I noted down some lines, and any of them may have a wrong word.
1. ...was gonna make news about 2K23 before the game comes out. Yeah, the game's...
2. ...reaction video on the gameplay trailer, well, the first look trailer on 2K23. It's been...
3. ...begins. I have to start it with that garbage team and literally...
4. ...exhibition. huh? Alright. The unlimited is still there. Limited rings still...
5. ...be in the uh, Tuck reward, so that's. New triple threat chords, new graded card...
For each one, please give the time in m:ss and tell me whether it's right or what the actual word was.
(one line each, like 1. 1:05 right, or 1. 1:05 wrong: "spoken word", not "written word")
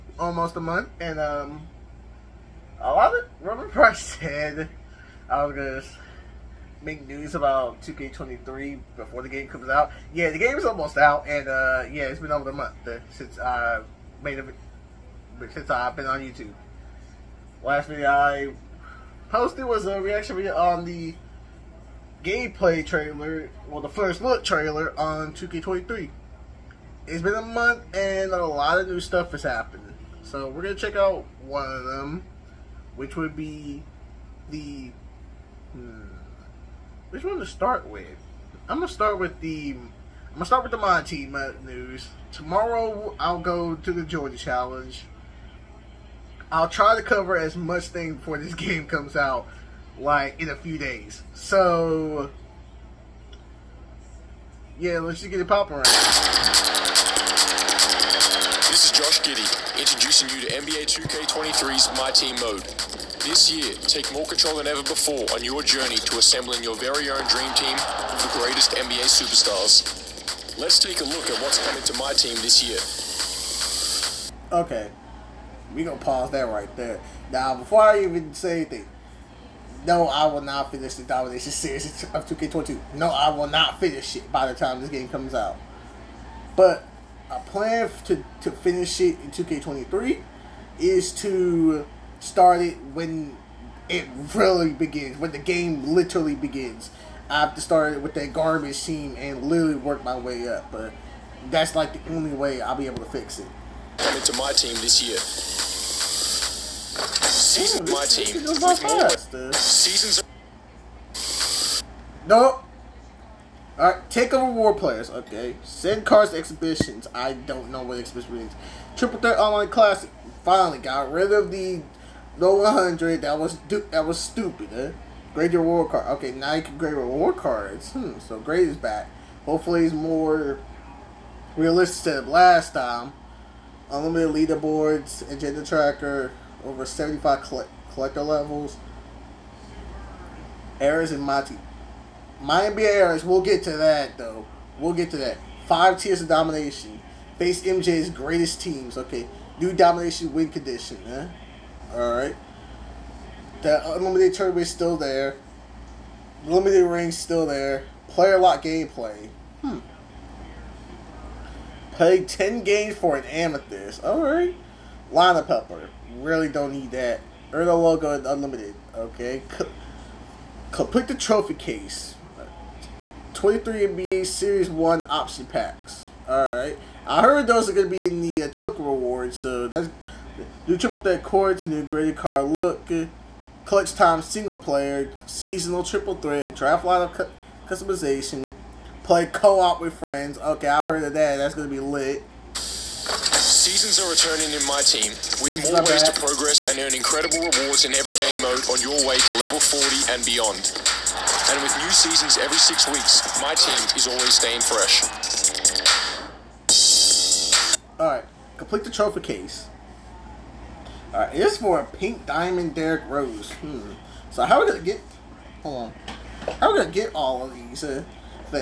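1. 0:05 right
2. 0:19 right
3. 1:36 right
4. 2:30 wrong: "condition", not "exhibition"
5. 2:57 right.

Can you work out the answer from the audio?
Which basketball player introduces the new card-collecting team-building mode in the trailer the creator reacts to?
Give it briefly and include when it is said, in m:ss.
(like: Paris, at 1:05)
Josh Giddey, at 0:58.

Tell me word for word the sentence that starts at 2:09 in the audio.
Hopefully it's more realistic than last time unlimited leaderboards, agenda tracker, over 75 collector levels.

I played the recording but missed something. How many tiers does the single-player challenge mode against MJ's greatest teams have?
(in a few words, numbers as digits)
5.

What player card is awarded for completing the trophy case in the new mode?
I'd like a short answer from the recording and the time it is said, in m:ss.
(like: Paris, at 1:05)
pink diamond Derrick Rose, at 3:31.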